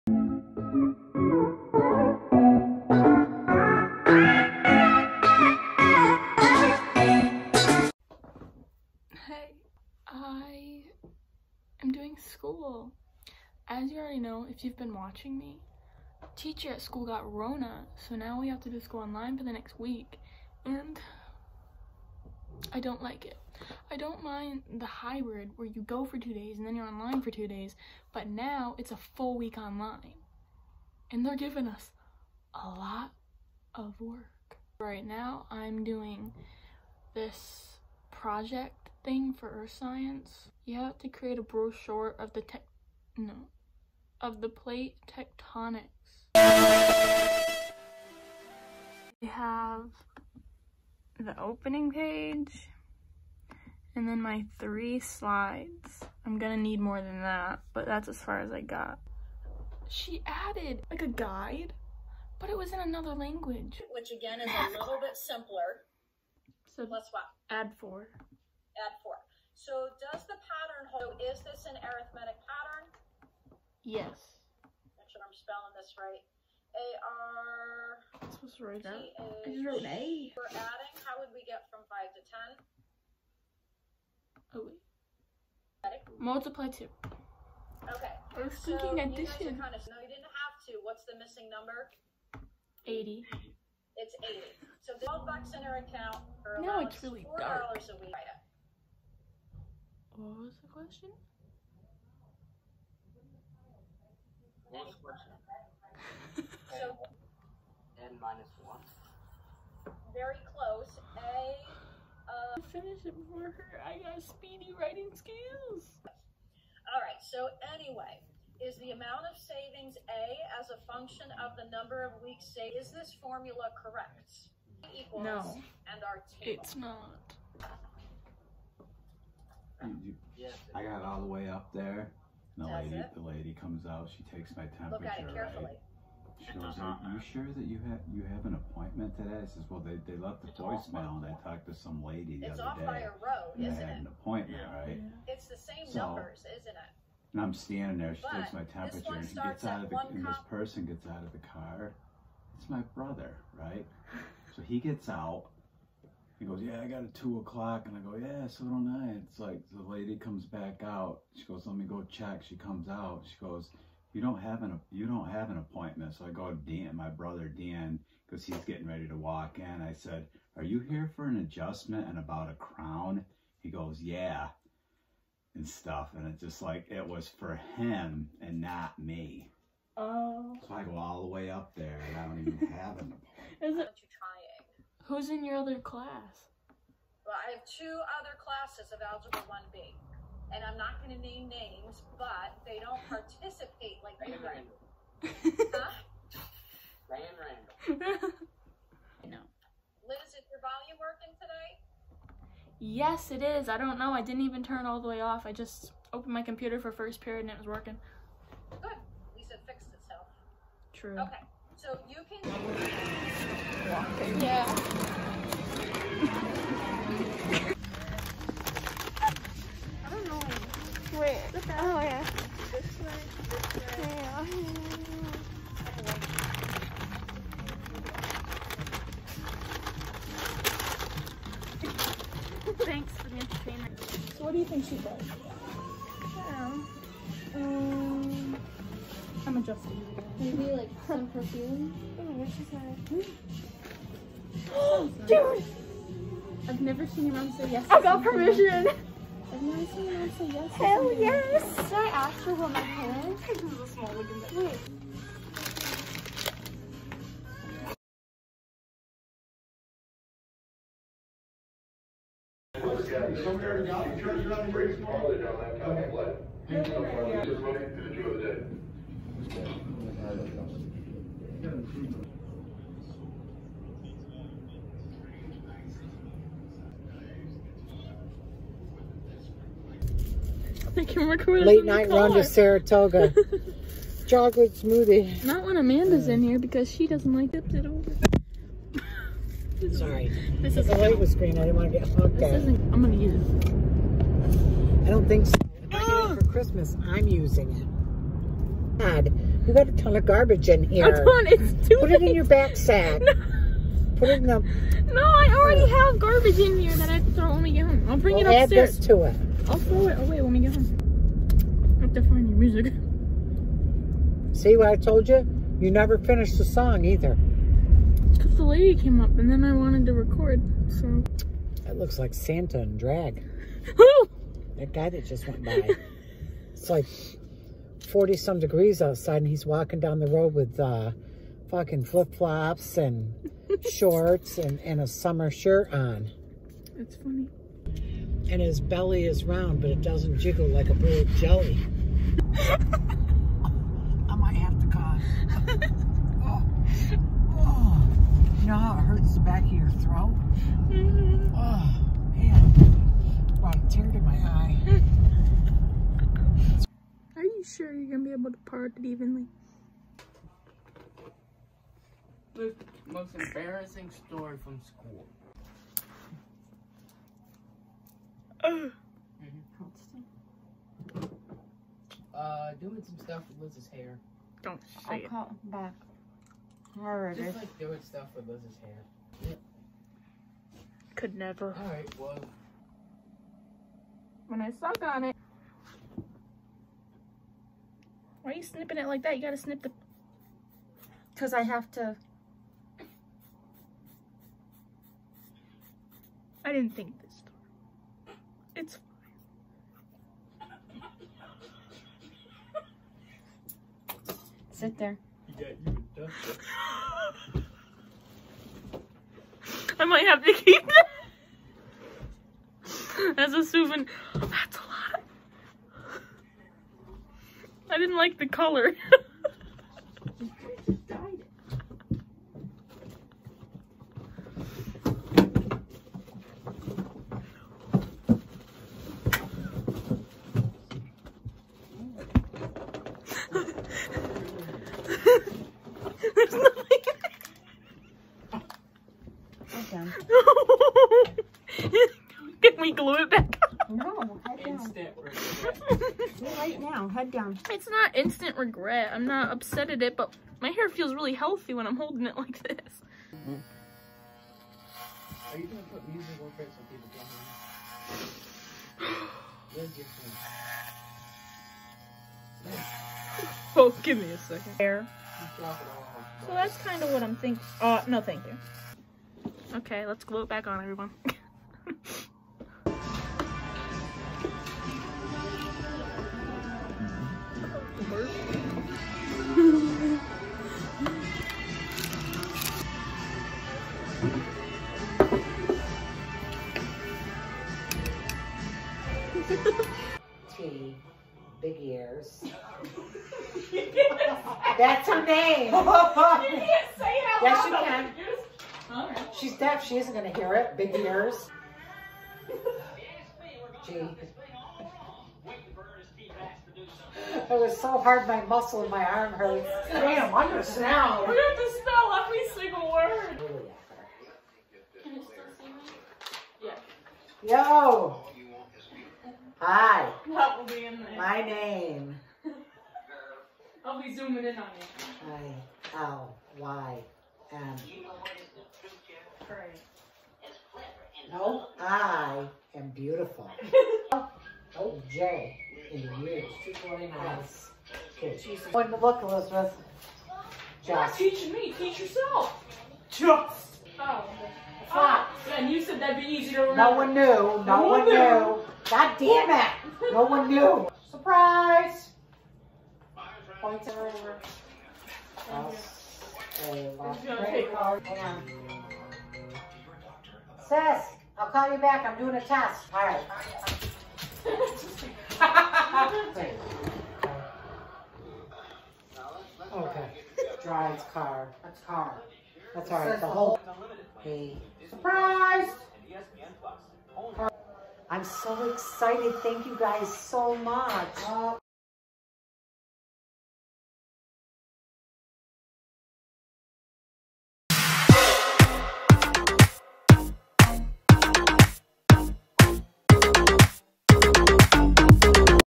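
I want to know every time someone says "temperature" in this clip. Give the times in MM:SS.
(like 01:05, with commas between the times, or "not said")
02:14, 02:28.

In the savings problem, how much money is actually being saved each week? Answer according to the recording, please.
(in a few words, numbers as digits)
4 dollars.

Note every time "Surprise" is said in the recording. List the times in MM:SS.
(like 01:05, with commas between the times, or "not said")
09:11, 09:34.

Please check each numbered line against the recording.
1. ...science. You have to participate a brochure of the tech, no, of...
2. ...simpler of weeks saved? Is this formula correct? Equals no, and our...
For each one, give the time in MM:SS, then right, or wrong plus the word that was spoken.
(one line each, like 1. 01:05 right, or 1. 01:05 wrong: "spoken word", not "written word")
1. 00:39 wrong: "create", not "participate"
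2. 02:01 wrong: "number", not "simpler".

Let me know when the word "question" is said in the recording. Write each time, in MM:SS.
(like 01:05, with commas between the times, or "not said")
01:40, 01:44.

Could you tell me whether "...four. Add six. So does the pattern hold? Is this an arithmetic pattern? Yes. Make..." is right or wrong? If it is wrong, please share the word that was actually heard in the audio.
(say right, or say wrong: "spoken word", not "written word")
wrong: "four", not "six".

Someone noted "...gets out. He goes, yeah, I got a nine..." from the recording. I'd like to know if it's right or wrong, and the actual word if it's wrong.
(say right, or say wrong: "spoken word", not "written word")
wrong: "two", not "nine".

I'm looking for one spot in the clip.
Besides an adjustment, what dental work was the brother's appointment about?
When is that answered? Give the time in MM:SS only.
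02:52.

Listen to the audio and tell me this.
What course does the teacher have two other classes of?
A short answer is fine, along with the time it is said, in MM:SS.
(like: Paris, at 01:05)
Algebra 1B, at 03:09.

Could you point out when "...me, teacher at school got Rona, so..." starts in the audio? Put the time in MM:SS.
00:15.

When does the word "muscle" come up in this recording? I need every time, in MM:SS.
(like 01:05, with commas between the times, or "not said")
08:28.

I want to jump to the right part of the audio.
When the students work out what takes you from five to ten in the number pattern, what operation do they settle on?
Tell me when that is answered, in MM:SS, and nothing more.
01:26.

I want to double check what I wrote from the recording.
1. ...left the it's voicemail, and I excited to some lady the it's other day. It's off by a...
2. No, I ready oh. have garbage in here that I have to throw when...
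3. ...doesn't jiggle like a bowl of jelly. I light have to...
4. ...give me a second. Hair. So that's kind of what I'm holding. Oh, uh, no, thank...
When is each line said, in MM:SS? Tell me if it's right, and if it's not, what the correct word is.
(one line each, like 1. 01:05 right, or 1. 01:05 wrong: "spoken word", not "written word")
1. 02:20 wrong: "talked", not "excited"
2. 05:05 wrong: "already", not "ready"
3. 05:40 wrong: "might", not "light"
4. 07:44 wrong: "thinking", not "holding".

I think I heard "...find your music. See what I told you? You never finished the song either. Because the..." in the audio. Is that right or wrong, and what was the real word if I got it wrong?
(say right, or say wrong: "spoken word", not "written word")
right.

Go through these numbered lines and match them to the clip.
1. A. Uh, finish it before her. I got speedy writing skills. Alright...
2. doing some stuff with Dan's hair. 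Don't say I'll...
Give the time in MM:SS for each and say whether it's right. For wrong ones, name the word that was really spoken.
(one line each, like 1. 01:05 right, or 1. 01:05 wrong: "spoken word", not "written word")
1. 01:51 right
2. 06:12 wrong: "Liz", not "Dan".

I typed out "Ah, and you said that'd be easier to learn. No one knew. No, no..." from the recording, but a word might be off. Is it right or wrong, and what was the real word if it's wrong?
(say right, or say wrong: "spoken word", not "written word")
right.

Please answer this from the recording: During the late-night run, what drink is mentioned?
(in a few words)
chocolate smoothie.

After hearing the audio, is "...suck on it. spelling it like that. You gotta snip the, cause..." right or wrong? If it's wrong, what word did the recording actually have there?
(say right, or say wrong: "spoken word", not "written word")
wrong: "snipping", not "spelling".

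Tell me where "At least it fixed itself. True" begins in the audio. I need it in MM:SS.
03:28.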